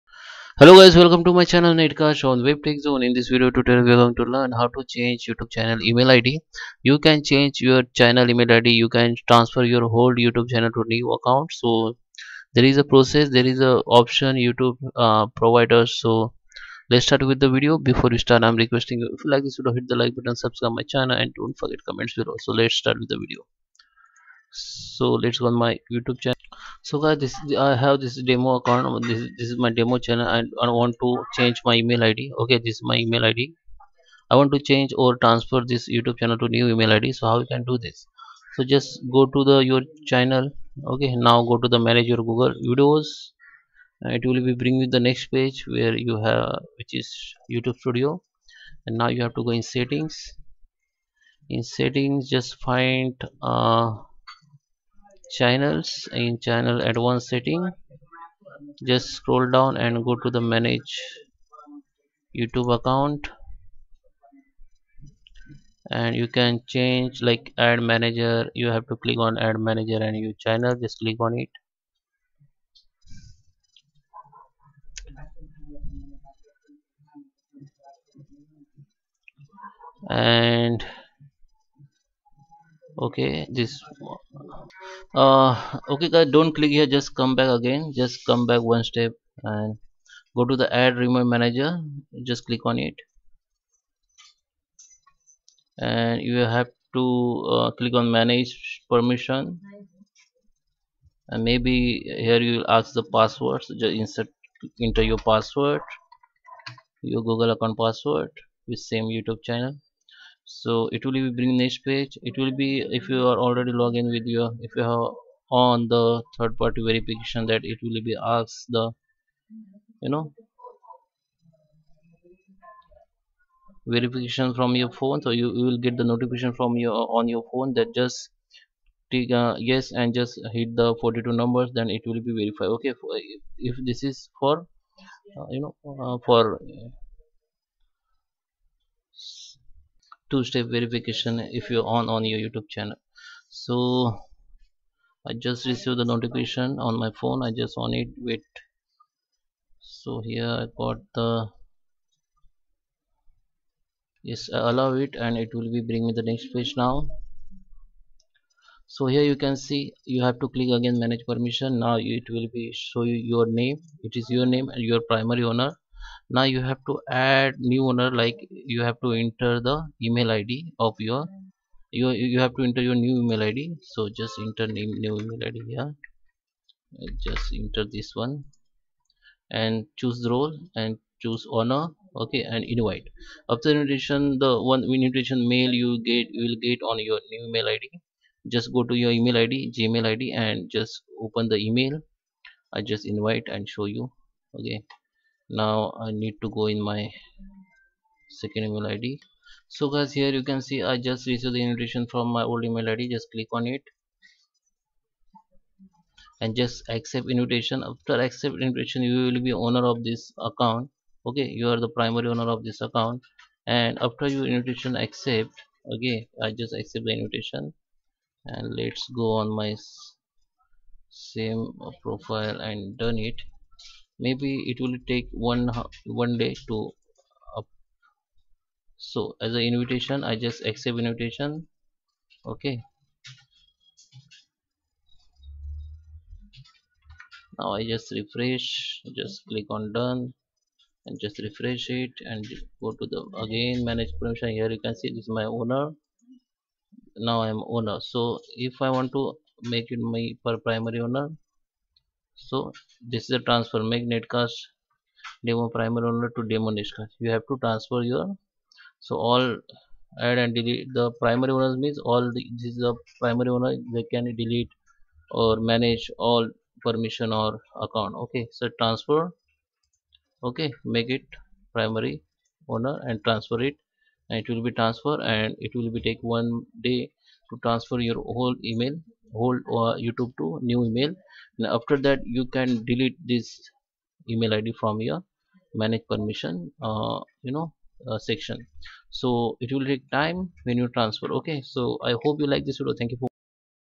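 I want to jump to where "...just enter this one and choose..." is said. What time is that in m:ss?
2:57.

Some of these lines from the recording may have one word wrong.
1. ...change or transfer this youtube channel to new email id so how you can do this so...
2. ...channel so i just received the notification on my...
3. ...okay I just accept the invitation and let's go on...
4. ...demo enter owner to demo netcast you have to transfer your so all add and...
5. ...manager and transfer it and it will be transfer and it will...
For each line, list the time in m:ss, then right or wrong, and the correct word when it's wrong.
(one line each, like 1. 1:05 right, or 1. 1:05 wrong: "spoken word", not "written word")
1. 0:34 right
2. 2:22 right
3. 3:35 right
4. 4:15 wrong: "primer", not "enter"
5. 4:32 wrong: "owner", not "manager".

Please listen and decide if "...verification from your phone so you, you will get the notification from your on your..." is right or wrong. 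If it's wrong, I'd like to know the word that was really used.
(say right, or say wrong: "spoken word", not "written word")
right.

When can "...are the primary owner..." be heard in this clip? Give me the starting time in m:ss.
3:31.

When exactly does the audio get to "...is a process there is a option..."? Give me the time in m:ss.
0:12.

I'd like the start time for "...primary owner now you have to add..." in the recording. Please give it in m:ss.
2:45.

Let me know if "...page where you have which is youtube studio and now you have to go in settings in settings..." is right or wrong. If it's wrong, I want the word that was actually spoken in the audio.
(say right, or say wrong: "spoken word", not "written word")
right.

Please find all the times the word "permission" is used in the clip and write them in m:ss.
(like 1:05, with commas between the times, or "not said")
1:38, 2:41, 4:04, 4:26, 4:46.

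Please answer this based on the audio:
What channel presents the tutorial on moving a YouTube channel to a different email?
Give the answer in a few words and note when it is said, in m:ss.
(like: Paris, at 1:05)
Netcast on Web Tech Zone, at 0:01.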